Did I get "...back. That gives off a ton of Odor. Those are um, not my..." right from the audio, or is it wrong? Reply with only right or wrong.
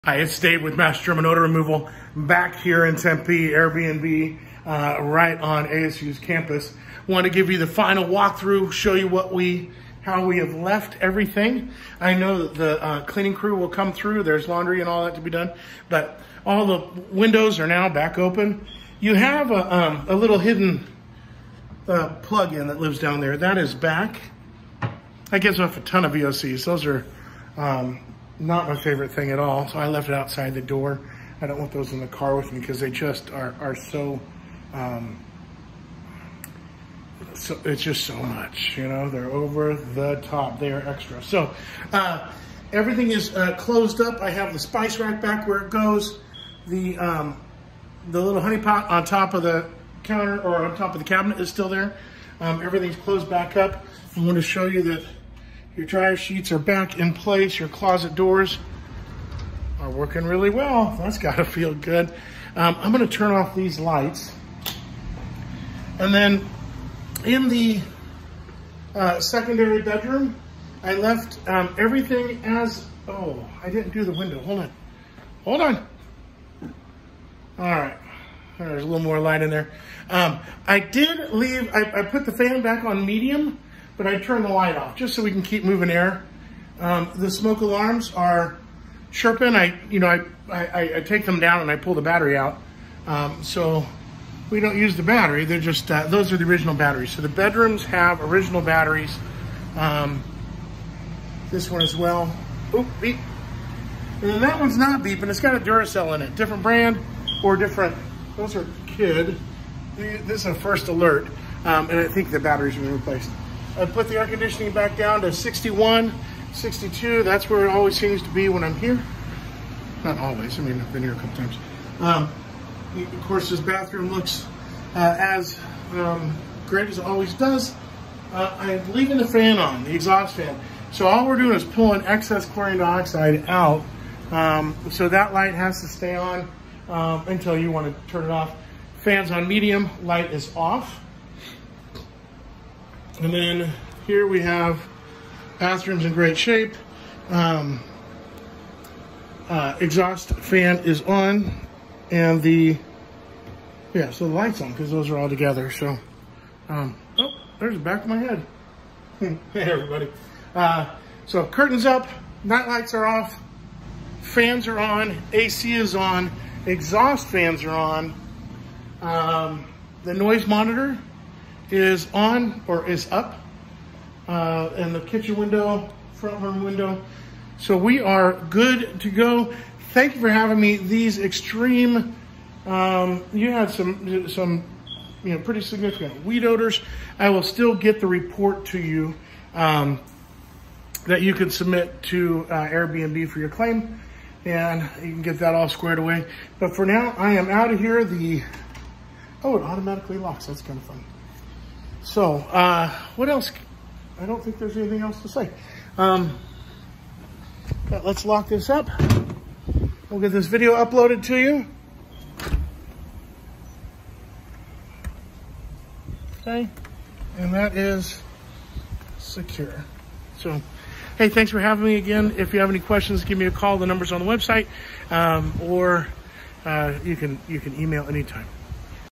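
wrong.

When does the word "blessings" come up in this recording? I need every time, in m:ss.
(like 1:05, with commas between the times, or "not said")
not said.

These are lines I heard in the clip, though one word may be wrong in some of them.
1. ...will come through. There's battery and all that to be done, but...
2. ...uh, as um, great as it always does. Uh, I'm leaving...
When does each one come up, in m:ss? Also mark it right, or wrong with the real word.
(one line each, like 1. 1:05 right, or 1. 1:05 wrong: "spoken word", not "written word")
1. 0:13 wrong: "laundry", not "battery"
2. 2:04 right.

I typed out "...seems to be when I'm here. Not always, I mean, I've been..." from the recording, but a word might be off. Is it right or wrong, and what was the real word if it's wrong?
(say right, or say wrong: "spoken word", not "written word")
right.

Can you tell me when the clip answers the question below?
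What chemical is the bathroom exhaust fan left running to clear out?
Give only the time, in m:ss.
2:12.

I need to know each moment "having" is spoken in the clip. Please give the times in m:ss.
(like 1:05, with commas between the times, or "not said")
3:00, 3:41.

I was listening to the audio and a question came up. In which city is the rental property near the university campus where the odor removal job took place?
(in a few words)
Tempe.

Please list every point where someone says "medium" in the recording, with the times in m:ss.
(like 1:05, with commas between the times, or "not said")
1:23, 2:19.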